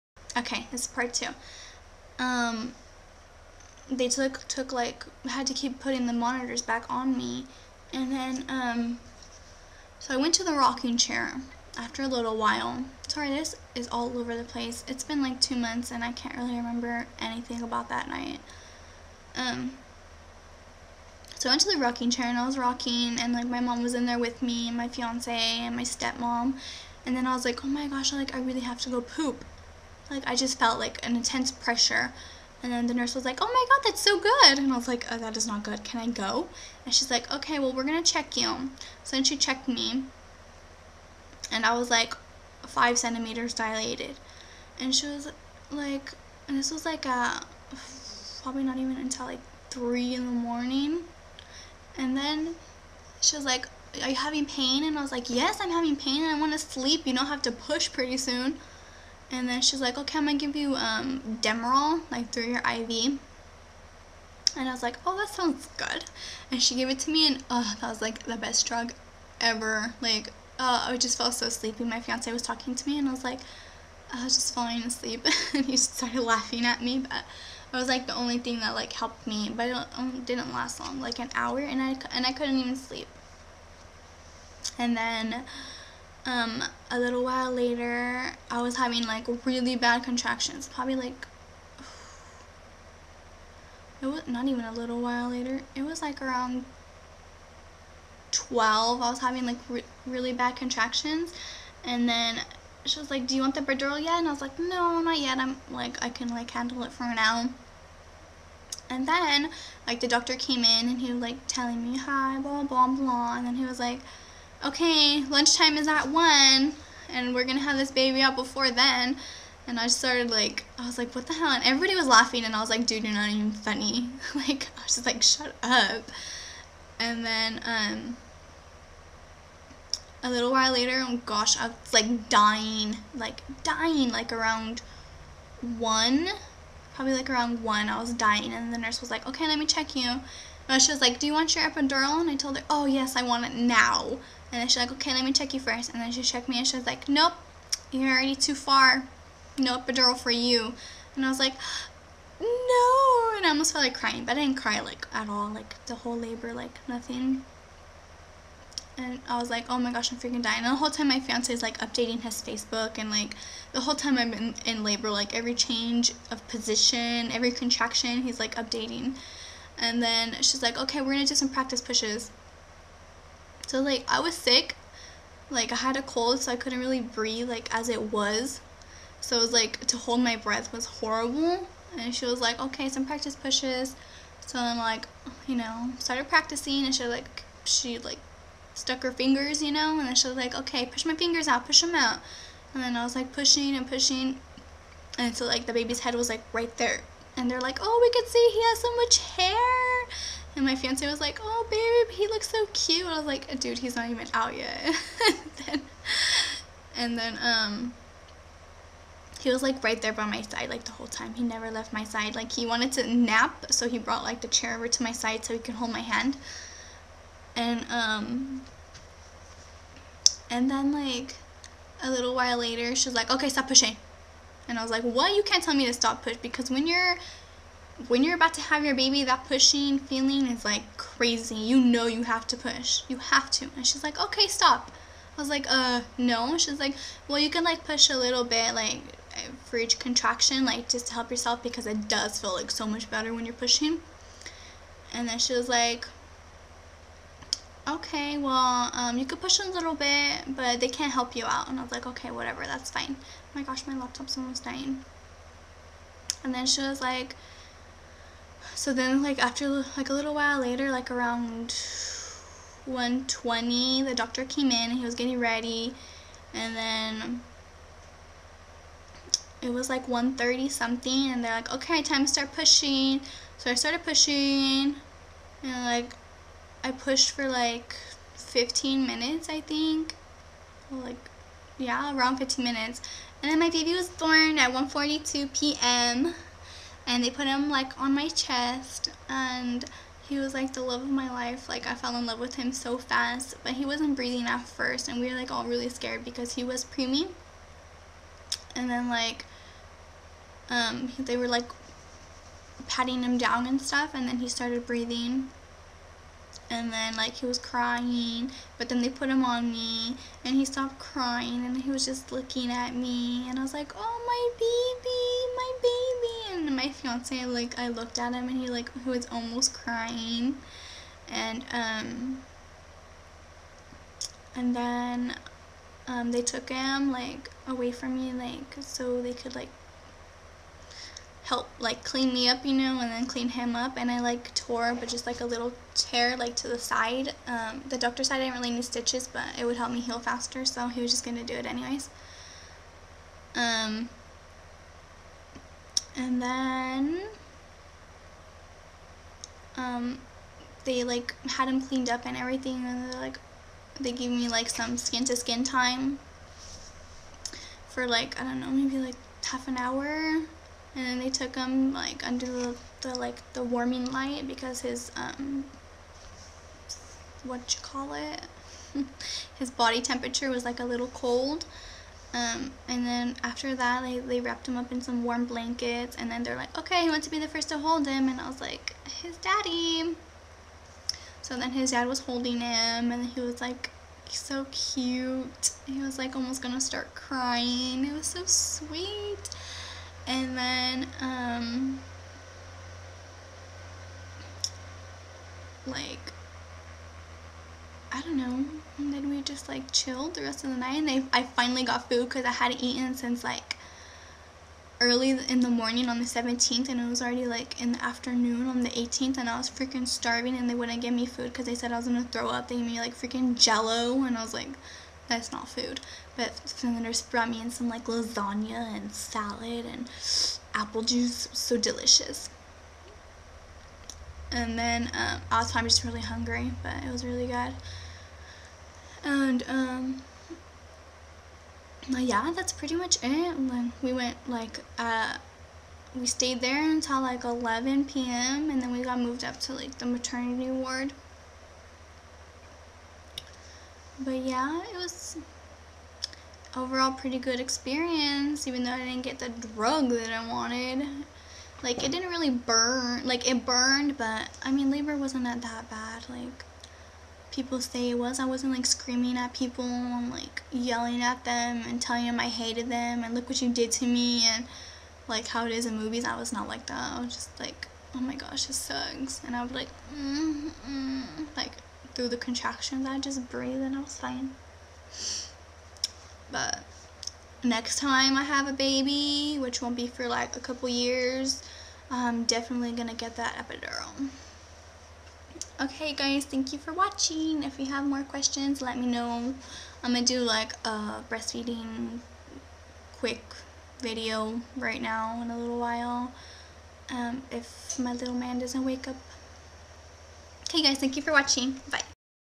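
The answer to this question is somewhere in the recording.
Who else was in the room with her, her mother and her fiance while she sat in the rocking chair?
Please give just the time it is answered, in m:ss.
0:25.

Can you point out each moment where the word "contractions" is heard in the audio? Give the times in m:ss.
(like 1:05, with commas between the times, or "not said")
1:30, 1:40, 2:47, 3:59, 7:52.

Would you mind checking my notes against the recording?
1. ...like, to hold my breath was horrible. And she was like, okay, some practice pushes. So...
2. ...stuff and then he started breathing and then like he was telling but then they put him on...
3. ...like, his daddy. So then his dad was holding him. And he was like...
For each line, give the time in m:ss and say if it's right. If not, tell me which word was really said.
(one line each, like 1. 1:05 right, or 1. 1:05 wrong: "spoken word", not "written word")
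1. 2:59 right
2. 5:03 wrong: "crying", not "telling"
3. 6:18 right.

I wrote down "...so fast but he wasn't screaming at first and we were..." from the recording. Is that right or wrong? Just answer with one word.
wrong.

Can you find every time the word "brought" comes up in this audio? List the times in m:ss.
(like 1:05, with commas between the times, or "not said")
3:33, 6:57.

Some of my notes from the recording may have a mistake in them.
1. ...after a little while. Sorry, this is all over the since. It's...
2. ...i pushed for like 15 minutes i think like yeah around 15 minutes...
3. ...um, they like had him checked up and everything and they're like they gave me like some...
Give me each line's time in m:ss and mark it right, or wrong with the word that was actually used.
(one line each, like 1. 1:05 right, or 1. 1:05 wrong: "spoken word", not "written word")
1. 0:11 wrong: "place", not "since"
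2. 4:36 right
3. 5:49 wrong: "cleaned", not "checked".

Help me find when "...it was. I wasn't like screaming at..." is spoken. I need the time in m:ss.
7:38.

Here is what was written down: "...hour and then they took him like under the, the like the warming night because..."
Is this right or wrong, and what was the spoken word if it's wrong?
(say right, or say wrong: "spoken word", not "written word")
wrong: "light", not "night".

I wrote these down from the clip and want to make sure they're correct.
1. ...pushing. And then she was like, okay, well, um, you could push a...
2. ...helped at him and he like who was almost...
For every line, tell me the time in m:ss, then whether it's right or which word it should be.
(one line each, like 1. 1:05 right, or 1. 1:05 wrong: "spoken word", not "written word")
1. 4:03 right
2. 5:17 wrong: "looked", not "helped".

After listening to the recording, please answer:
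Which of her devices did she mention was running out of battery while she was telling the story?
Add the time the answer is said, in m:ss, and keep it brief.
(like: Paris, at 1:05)
Laptop, at 4:13.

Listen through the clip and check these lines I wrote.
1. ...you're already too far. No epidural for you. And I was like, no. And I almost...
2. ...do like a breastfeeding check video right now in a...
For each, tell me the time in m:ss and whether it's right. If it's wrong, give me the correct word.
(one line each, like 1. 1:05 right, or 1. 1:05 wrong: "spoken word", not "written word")
1. 2:27 right
2. 8:10 wrong: "quick", not "check".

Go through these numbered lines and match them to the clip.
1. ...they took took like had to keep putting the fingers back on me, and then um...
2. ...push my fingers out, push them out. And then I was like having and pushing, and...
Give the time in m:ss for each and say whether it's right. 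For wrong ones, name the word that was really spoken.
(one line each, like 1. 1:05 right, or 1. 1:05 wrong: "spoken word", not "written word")
1. 0:03 wrong: "monitors", not "fingers"
2. 3:10 wrong: "pushing", not "having".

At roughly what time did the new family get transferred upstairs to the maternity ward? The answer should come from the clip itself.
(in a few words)
11 p.m.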